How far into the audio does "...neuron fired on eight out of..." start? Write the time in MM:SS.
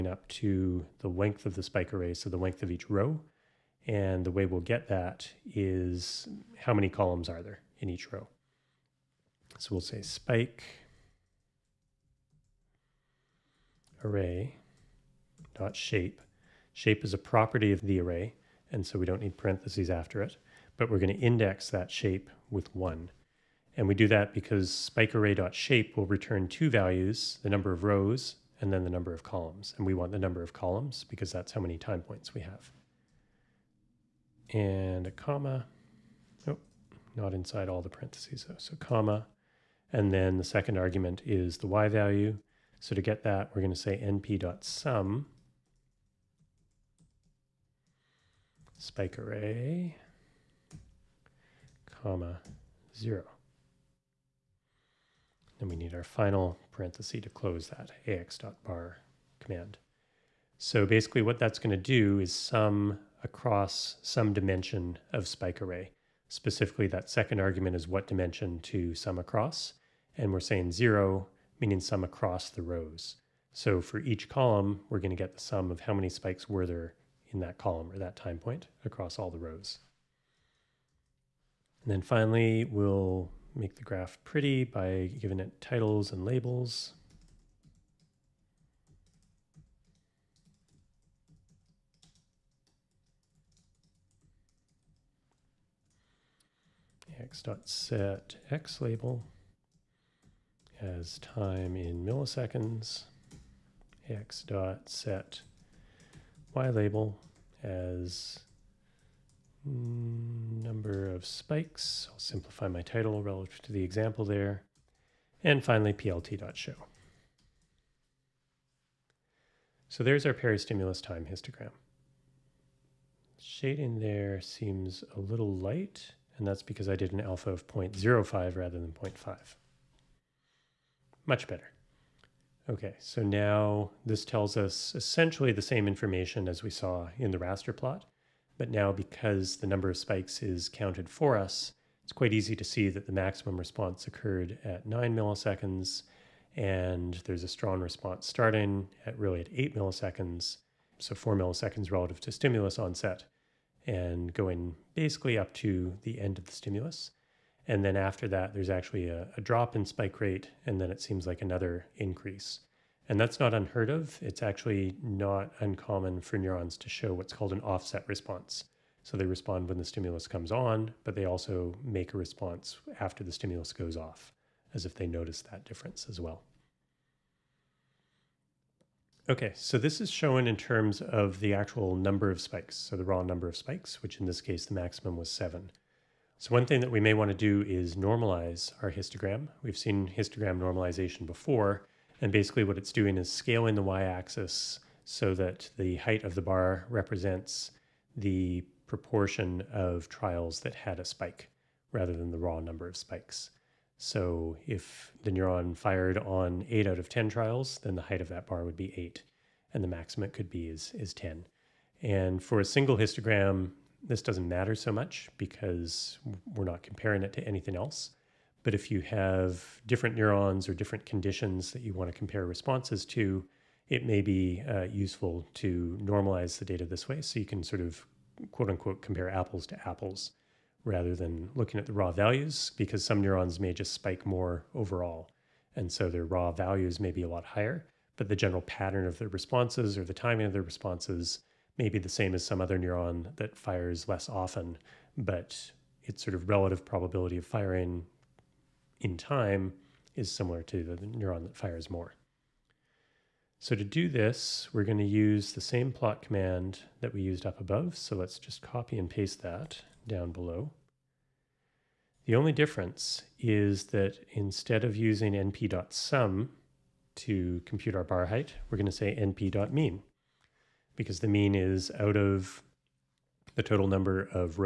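03:25.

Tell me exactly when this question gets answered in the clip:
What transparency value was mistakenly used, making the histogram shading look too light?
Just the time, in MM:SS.
02:07.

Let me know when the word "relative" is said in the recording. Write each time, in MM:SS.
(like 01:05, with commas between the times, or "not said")
01:53, 02:31, 04:06.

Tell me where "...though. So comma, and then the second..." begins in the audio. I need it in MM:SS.
00:38.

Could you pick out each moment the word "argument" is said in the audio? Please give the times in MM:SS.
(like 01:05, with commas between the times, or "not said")
00:40, 01:07.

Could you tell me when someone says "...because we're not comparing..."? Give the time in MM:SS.
03:35.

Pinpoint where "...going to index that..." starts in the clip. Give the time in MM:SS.
00:20.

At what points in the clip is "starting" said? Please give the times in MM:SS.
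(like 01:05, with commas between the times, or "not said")
02:28.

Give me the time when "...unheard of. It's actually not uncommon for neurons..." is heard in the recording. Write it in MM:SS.
02:43.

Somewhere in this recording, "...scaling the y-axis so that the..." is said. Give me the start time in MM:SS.
03:13.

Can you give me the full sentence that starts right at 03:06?
So one thing that we may want to do is normalize our histogram.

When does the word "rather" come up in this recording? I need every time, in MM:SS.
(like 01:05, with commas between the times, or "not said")
02:08, 03:21, 03:50.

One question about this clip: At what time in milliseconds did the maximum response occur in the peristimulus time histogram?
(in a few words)
9 milliseconds.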